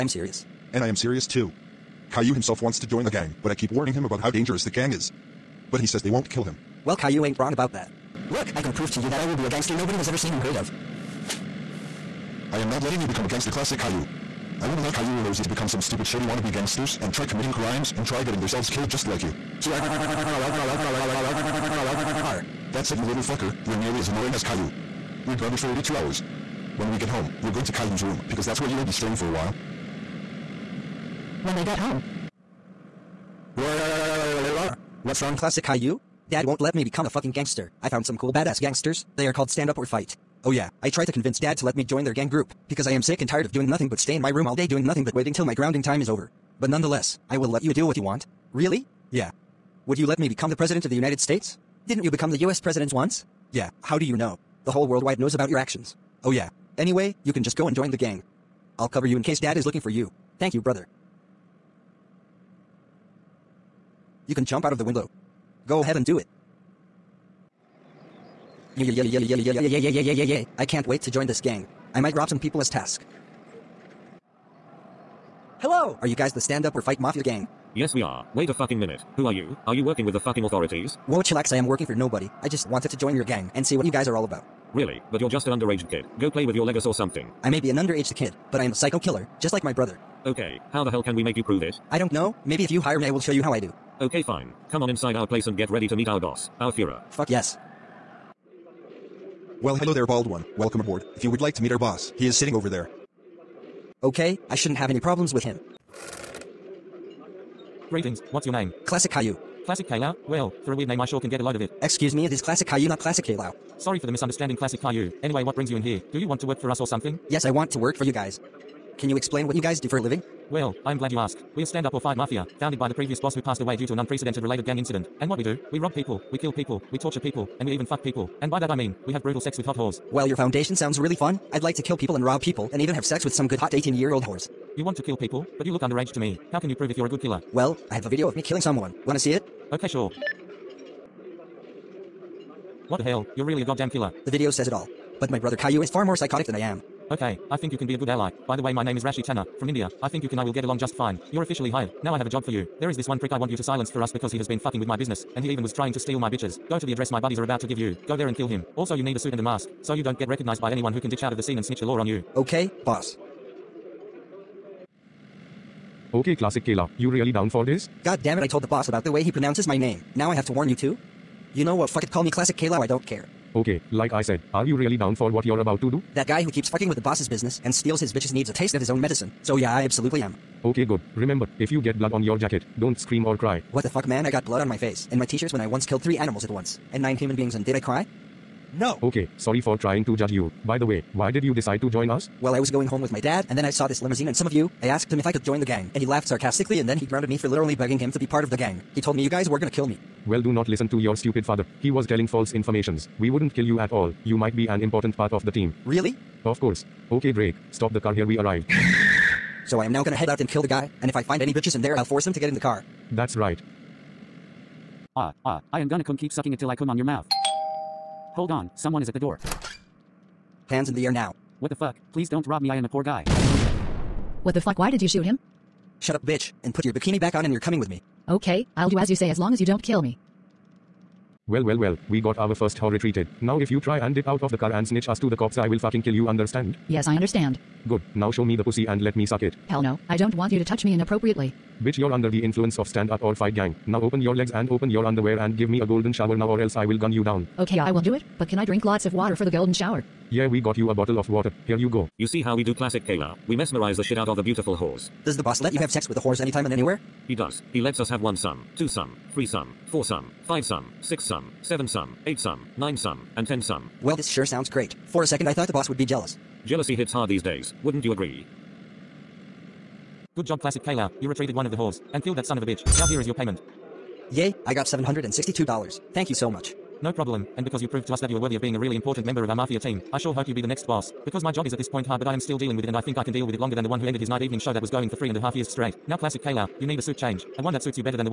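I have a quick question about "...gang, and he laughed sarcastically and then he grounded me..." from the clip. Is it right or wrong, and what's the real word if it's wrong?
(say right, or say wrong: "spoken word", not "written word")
right.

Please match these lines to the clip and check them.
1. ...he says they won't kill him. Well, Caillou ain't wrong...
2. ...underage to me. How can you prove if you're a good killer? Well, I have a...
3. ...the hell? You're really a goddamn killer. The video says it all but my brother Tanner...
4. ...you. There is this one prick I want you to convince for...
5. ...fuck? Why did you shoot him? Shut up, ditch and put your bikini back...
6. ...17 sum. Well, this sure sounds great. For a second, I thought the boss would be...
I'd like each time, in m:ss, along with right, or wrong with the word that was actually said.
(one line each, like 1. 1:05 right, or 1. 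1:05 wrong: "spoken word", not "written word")
1. 0:05 right
2. 2:15 right
3. 2:22 wrong: "Caillou", not "Tanner"
4. 2:32 wrong: "silence", not "convince"
5. 3:44 wrong: "bitch", not "ditch"
6. 4:23 wrong: "10", not "17".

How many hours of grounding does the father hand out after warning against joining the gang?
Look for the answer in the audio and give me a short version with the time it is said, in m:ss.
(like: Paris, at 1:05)
82 hours, at 0:25.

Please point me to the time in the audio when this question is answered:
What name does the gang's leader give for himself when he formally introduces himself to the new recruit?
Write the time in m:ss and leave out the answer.
2:29.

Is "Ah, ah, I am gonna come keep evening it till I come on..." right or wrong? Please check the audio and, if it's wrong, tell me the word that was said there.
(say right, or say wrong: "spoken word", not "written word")
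wrong: "sucking", not "evening".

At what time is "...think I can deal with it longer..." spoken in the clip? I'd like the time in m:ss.
4:43.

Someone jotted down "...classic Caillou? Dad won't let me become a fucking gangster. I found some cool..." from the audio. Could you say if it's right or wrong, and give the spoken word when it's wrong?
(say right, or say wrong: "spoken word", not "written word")
right.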